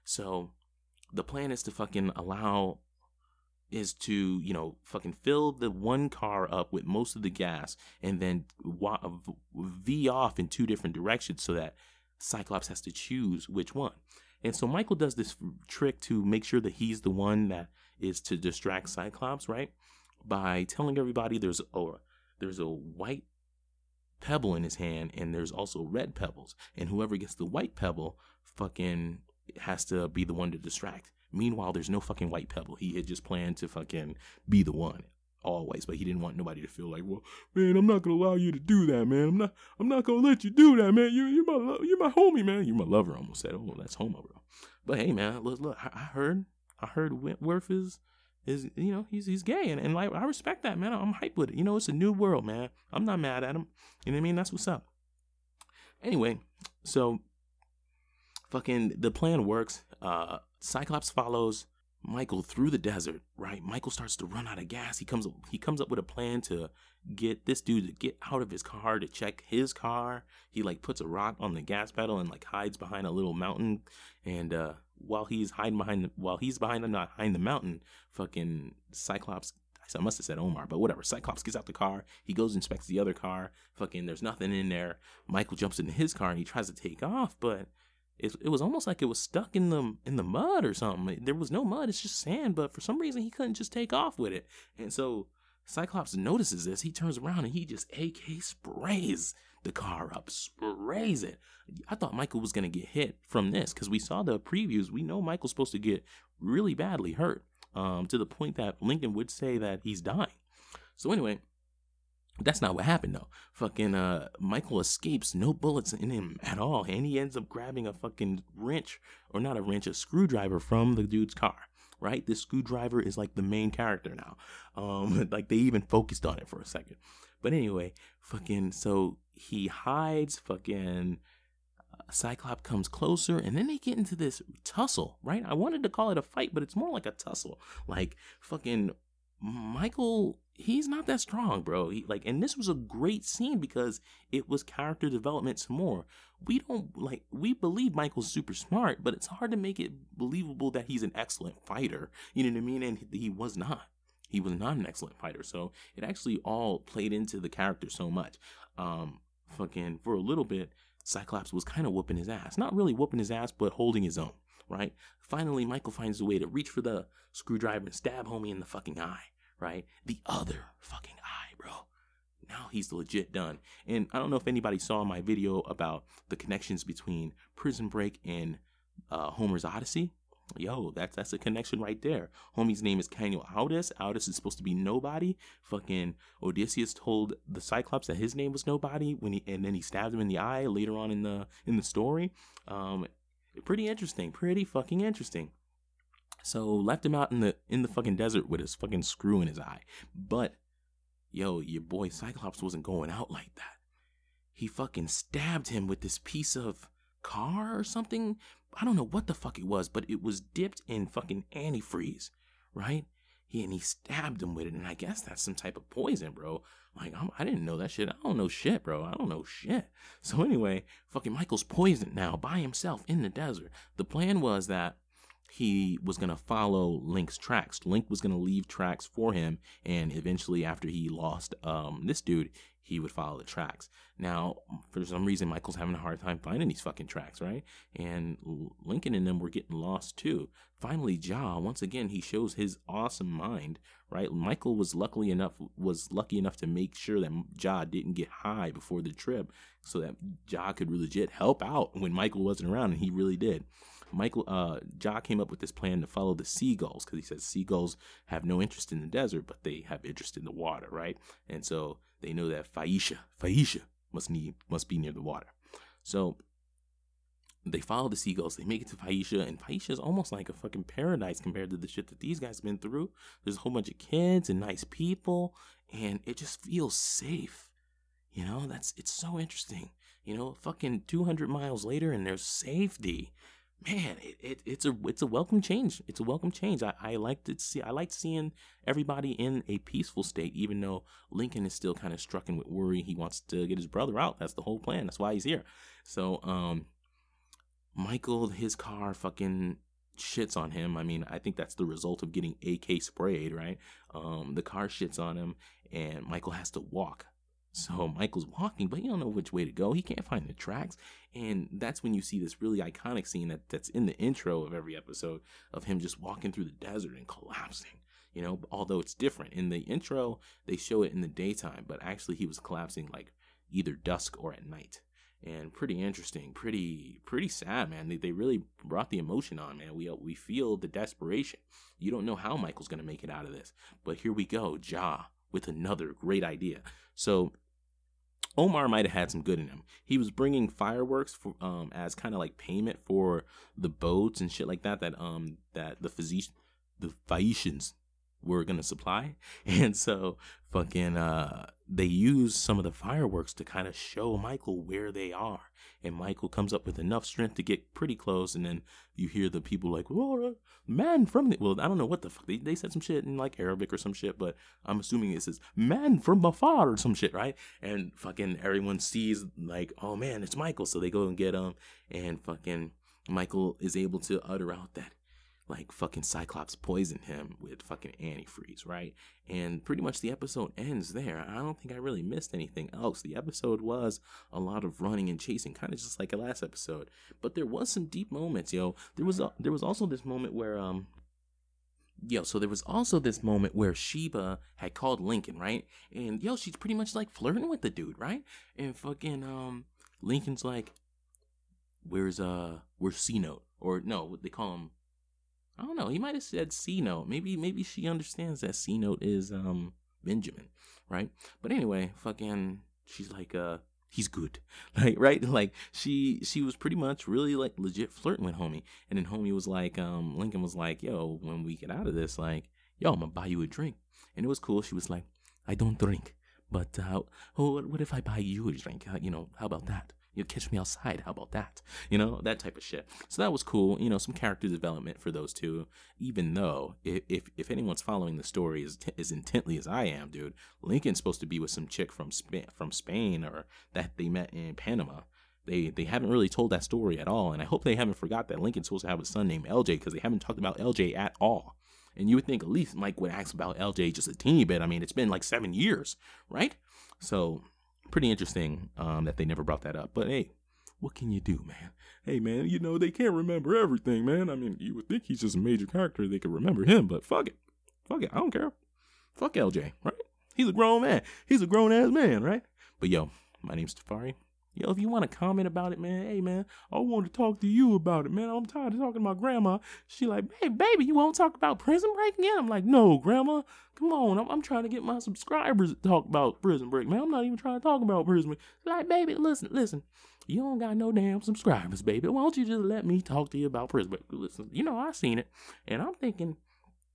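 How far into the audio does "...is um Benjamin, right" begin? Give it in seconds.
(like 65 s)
409 s.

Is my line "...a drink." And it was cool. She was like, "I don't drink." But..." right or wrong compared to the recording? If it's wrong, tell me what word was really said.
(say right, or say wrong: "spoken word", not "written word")
right.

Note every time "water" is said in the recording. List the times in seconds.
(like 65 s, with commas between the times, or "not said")
260 s, 265 s.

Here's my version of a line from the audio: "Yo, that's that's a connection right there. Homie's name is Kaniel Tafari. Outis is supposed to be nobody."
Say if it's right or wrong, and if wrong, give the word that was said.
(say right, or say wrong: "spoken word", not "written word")
wrong: "Outis", not "Tafari".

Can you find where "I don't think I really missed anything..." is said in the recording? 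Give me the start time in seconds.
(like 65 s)
381 s.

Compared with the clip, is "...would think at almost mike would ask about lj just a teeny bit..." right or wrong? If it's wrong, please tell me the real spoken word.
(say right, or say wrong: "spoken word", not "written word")
wrong: "least", not "almost".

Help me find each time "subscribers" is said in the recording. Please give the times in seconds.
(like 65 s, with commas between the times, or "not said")
485 s, 491 s.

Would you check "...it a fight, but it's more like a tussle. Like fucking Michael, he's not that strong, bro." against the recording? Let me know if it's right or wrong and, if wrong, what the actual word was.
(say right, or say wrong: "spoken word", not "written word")
right.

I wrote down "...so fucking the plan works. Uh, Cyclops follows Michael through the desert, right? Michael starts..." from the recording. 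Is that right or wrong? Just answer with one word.
right.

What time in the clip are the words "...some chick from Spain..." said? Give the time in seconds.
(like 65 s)
441 s.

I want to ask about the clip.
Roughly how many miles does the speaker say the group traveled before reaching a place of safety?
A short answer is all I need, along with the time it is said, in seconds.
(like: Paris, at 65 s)
200, at 281 s.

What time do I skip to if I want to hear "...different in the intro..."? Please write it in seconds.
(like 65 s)
319 s.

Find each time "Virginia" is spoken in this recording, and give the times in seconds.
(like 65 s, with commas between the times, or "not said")
not said.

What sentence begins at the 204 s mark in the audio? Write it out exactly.
He fucking stabbed him with this piece of car or something.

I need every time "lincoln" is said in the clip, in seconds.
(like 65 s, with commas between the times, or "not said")
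108 s, 238 s, 291 s, 395 s, 400 s, 420 s, 440 s, 448 s.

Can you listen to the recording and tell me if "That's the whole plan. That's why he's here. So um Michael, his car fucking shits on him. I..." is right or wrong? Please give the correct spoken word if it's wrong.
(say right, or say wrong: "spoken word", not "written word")
right.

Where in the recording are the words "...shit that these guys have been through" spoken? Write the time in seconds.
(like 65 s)
271 s.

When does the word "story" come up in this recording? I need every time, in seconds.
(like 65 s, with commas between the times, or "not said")
191 s, 438 s, 446 s.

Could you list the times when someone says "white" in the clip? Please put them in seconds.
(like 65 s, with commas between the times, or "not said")
22 s, 27 s, 32 s.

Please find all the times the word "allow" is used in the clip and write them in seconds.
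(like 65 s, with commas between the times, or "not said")
2 s, 38 s.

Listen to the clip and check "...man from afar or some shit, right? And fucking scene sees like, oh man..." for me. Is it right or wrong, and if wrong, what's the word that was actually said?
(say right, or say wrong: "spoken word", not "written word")
wrong: "everyone", not "scene".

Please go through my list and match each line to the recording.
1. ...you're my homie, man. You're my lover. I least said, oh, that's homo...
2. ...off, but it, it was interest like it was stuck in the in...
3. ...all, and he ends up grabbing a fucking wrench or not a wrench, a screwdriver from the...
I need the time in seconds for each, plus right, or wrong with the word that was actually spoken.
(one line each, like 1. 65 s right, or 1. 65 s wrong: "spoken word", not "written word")
1. 41 s wrong: "almost", not "least"
2. 87 s wrong: "almost", not "interest"
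3. 116 s right.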